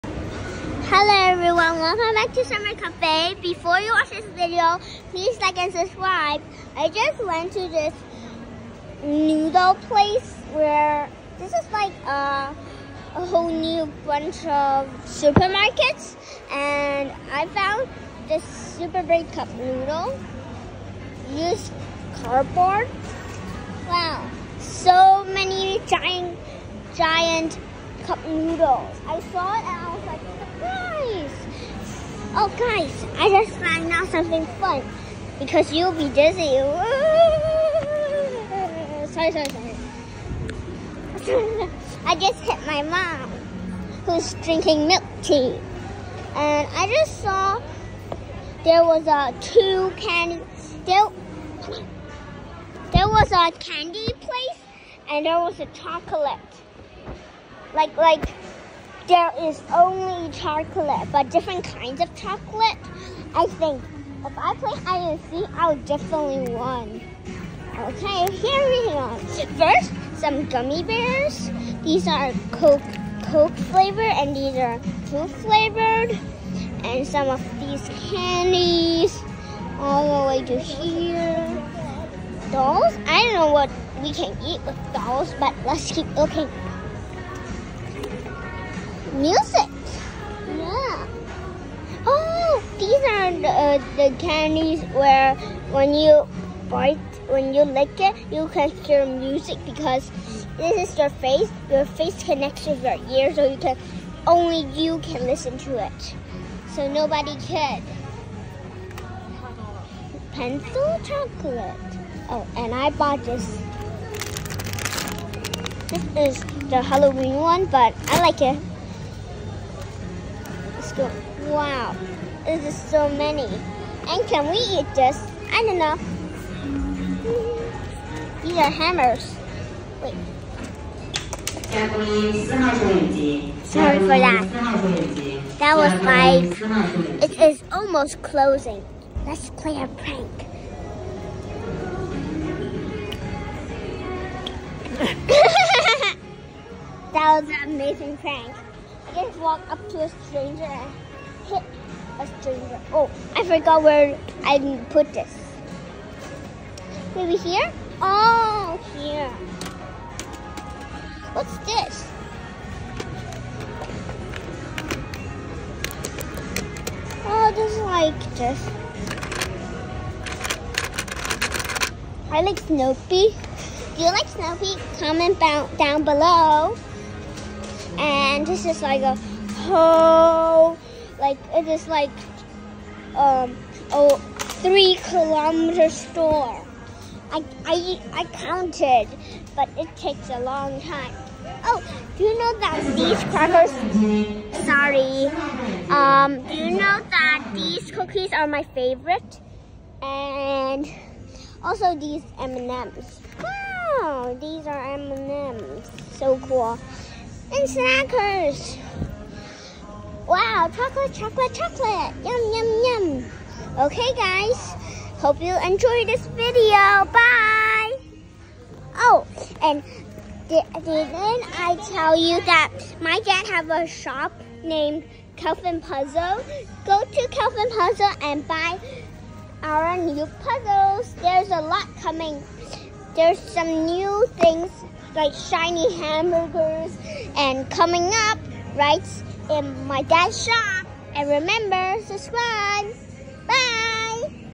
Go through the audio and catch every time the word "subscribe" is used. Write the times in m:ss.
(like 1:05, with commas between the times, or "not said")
0:05, 4:02.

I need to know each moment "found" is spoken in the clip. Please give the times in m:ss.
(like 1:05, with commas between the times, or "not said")
0:17, 0:33.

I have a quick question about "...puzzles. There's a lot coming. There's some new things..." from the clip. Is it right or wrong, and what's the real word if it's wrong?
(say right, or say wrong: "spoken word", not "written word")
right.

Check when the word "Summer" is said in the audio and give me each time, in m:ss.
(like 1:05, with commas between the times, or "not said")
0:02.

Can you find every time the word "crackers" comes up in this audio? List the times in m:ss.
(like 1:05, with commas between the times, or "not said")
3:13.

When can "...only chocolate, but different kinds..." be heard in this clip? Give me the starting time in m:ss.
0:59.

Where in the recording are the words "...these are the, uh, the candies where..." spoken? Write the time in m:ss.
1:32.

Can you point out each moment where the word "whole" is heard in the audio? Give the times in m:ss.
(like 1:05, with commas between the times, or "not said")
0:13, 2:59.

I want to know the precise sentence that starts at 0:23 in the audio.
Wow, so many giant, giant cup noodles.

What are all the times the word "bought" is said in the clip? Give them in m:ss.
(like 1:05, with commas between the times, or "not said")
1:52.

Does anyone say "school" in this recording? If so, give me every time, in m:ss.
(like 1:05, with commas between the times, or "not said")
2:00.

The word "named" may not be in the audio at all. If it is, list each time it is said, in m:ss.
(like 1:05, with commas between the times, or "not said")
3:44.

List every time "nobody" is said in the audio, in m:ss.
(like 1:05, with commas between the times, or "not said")
1:46.